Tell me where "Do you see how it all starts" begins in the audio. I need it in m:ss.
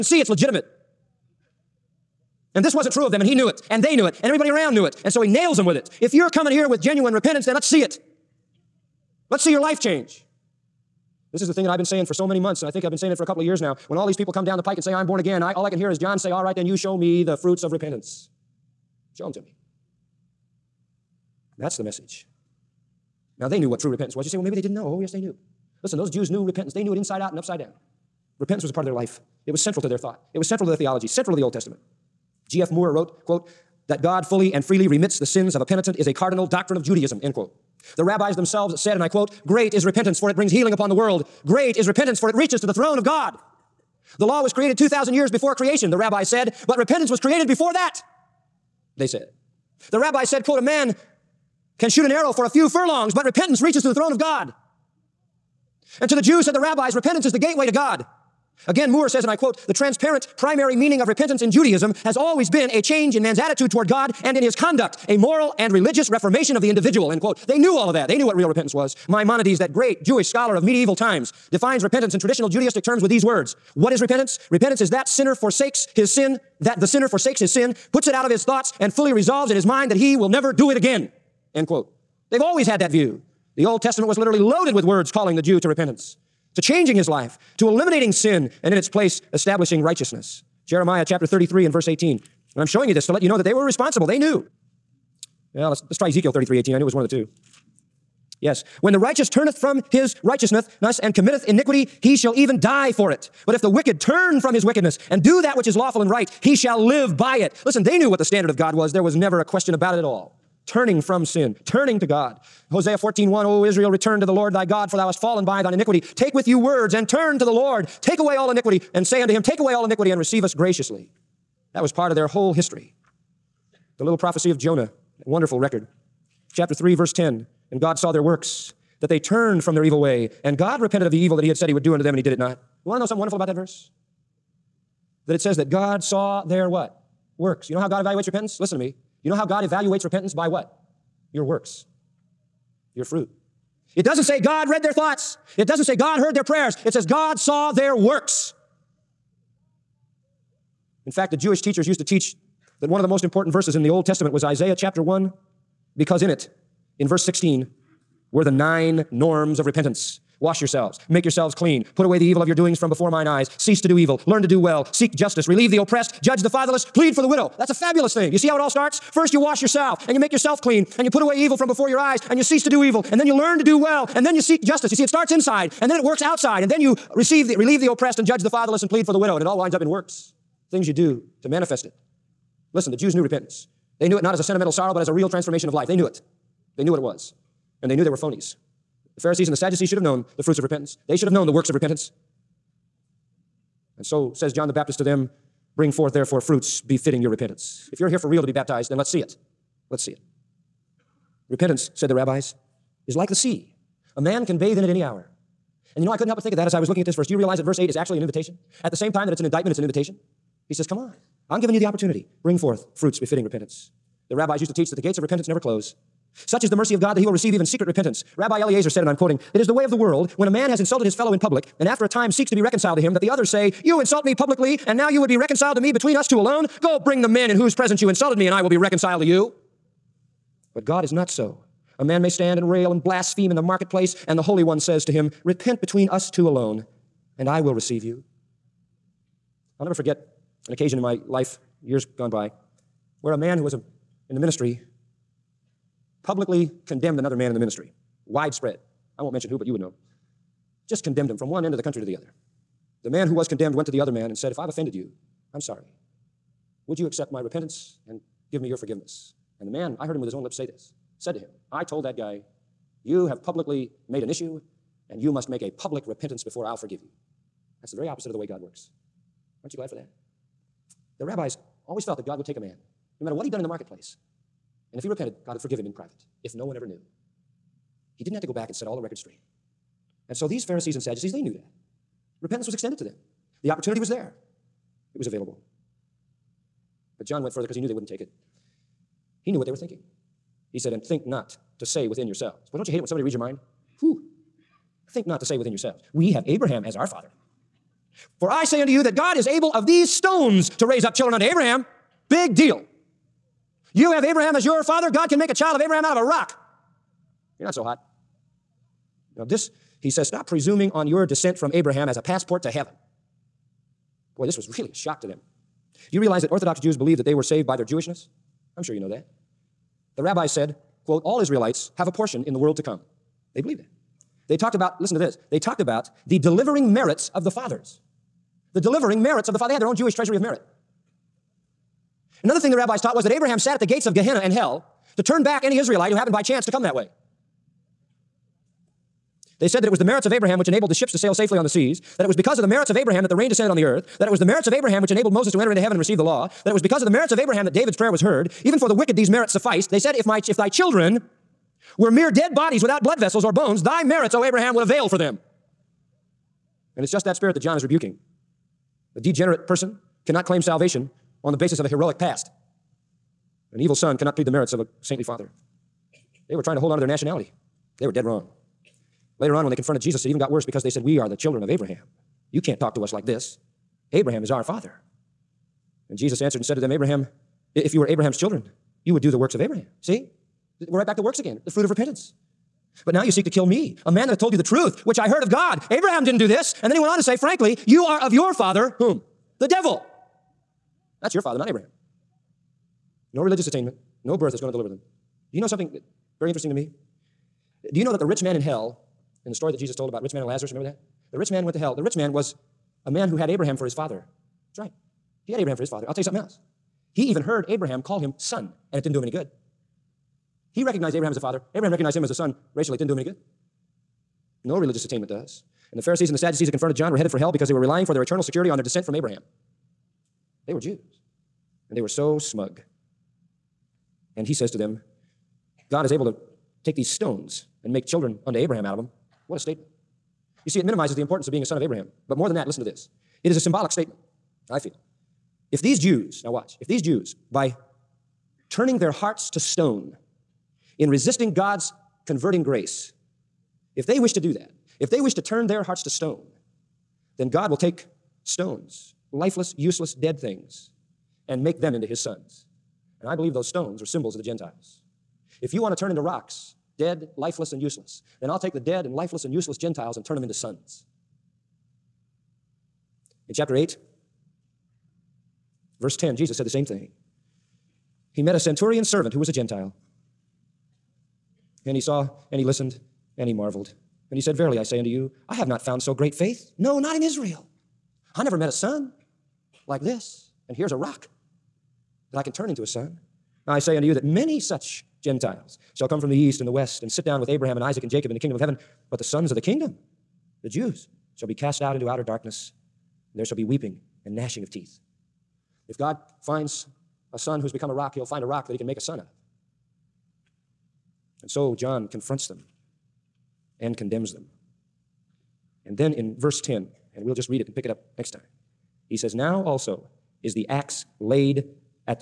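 2:48.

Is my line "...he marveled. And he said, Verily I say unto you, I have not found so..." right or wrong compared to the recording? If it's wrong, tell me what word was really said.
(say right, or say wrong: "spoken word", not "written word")
right.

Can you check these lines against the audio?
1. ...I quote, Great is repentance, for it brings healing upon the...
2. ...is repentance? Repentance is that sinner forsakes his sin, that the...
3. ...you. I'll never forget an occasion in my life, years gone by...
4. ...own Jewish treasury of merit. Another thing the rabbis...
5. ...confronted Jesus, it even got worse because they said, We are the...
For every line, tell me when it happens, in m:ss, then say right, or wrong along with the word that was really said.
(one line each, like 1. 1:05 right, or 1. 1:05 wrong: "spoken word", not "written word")
1. 0:39 right
2. 1:13 right
3. 3:58 right
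4. 5:29 right
5. 6:09 right.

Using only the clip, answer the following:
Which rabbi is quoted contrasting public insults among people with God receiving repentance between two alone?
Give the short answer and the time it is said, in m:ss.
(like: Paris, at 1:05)
Rabbi Eliezer, at 3:38.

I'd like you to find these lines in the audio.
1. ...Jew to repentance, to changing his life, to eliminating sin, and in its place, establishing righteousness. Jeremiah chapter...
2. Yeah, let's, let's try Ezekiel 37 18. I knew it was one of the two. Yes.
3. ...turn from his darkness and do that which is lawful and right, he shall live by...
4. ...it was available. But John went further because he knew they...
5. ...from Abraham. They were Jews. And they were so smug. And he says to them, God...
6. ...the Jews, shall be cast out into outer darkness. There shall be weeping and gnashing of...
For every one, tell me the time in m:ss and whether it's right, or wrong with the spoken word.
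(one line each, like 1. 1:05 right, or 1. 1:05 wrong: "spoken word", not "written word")
1. 1:25 right
2. 1:35 wrong: "33", not "37"
3. 1:43 wrong: "wickedness", not "darkness"
4. 4:45 right
5. 6:59 right
6. 8:10 right.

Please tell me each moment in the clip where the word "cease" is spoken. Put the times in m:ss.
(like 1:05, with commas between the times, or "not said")
2:43, 2:52.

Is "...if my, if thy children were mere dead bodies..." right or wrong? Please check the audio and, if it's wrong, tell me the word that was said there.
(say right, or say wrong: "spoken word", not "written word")
right.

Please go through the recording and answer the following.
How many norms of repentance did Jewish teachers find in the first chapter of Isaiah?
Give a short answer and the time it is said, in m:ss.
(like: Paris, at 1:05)
9, at 2:38.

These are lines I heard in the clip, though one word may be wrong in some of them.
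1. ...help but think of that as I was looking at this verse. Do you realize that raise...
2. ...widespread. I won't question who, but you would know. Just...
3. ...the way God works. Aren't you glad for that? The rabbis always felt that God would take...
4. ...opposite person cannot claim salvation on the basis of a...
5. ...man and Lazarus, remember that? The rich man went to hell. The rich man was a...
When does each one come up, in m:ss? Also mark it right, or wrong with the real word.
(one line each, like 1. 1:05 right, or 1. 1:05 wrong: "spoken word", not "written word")
1. 3:26 wrong: "verse", not "raise"
2. 4:08 wrong: "mention", not "question"
3. 4:28 right
4. 5:59 wrong: "degenerate", not "opposite"
5. 6:40 right.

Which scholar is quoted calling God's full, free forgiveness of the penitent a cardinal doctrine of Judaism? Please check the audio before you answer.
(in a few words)
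G.F. Moore.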